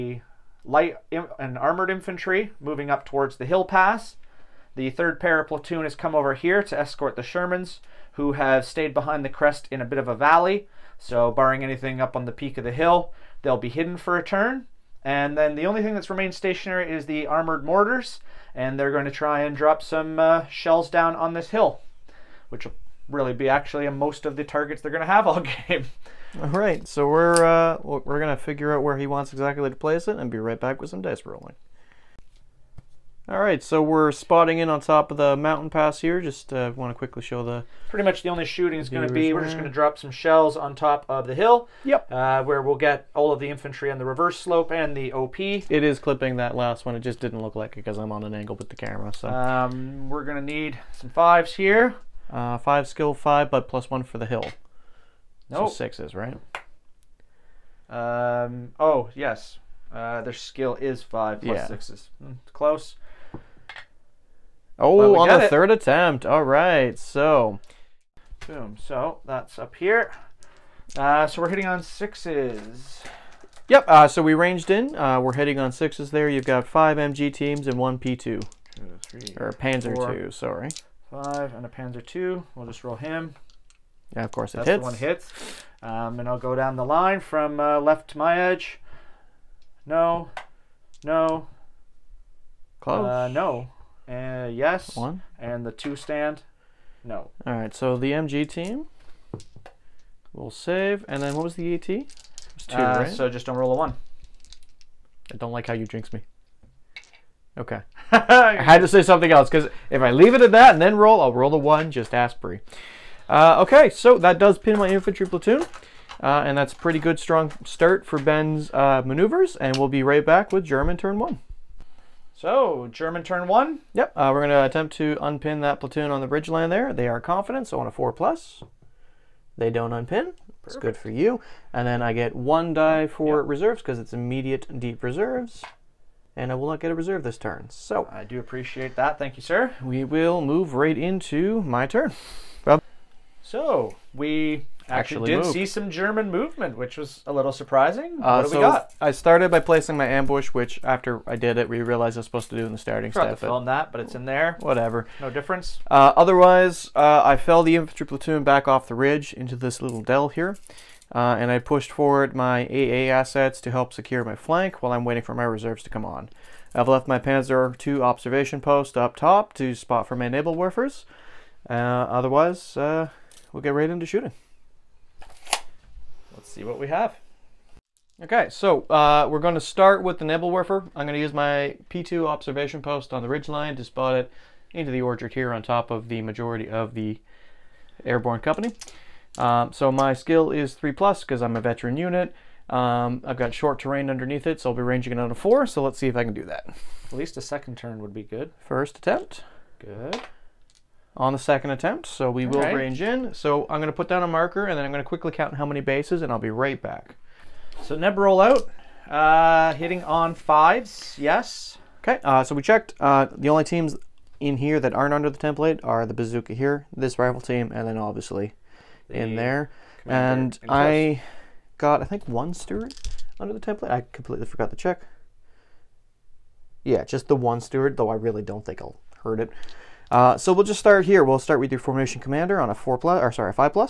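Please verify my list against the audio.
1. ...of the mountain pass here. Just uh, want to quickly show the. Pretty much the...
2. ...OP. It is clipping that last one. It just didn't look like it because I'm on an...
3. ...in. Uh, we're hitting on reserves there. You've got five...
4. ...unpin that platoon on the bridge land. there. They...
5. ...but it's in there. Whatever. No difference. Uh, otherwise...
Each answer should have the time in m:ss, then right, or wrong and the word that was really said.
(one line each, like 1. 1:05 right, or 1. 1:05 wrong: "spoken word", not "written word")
1. 0:35 right
2. 0:45 right
3. 1:14 wrong: "sixes", not "reserves"
4. 2:05 right
5. 2:33 right.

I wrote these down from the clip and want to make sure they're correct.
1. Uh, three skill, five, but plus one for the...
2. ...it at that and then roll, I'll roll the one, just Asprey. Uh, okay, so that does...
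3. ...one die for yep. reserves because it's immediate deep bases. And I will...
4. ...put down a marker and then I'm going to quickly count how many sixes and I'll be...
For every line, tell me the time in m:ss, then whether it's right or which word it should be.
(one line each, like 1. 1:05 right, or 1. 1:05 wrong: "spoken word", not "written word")
1. 0:52 wrong: "five", not "three"
2. 1:50 right
3. 2:12 wrong: "reserves", not "bases"
4. 3:23 wrong: "bases", not "sixes".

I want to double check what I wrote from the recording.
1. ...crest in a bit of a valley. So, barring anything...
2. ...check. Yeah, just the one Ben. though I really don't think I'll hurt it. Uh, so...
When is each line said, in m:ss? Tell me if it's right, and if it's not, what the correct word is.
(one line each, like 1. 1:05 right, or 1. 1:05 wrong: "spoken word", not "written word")
1. 0:09 right
2. 3:44 wrong: "Stuart", not "Ben".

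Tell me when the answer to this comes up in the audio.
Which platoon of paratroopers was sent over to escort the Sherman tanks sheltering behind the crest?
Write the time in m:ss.
0:04.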